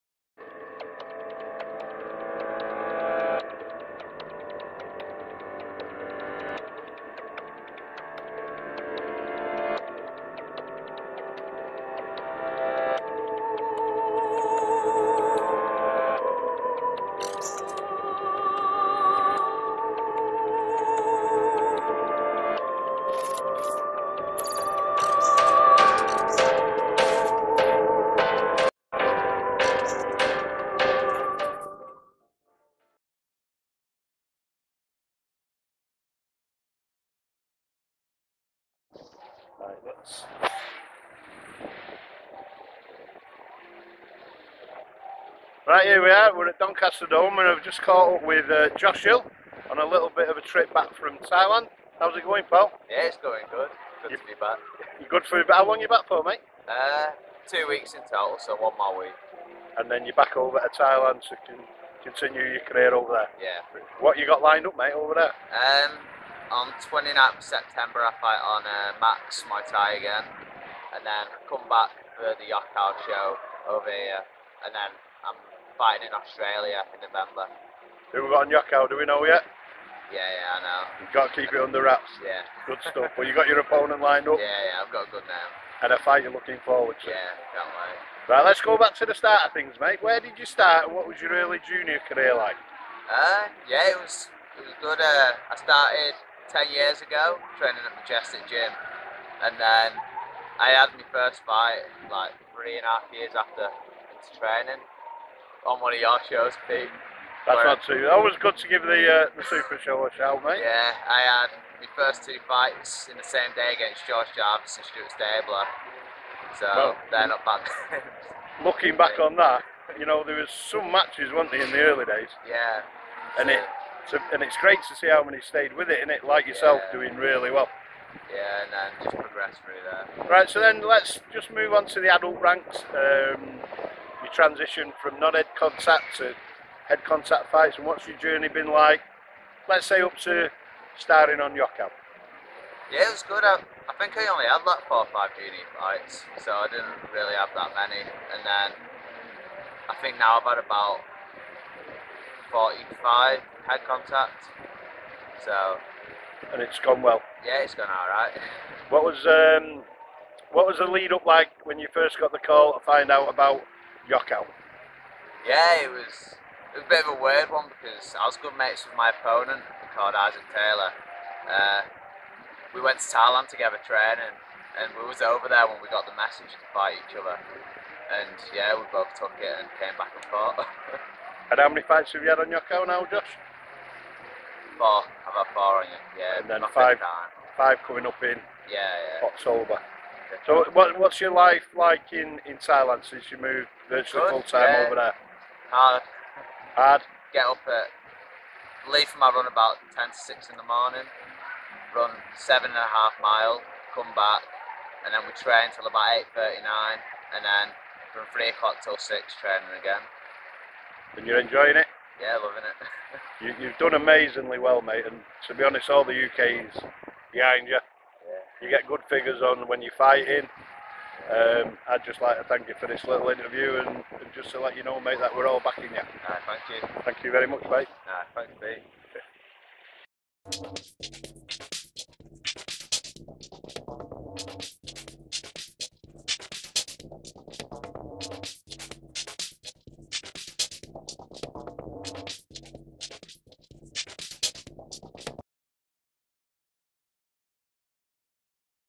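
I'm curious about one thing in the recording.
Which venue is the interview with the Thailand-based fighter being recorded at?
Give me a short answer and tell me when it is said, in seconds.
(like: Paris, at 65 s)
Doncaster Dome, at 46 s.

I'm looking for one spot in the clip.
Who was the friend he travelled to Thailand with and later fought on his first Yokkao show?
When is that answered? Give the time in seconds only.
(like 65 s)
170 s.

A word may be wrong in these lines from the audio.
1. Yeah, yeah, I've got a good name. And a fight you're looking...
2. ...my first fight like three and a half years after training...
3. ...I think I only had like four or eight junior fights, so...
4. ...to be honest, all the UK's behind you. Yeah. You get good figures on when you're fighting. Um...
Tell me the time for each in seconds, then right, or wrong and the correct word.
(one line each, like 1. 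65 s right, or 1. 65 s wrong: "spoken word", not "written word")
1. 84 s right
2. 100 s right
3. 143 s wrong: "five", not "eight"
4. 215 s right.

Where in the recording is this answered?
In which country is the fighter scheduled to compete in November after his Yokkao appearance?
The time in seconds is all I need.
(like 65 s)
76 s.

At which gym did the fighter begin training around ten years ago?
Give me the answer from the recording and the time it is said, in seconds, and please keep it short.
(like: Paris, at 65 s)
Majestic Gym, at 97 s.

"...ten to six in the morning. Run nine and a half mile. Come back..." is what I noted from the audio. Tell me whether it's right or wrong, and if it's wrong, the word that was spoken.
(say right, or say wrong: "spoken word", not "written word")
wrong: "seven", not "nine".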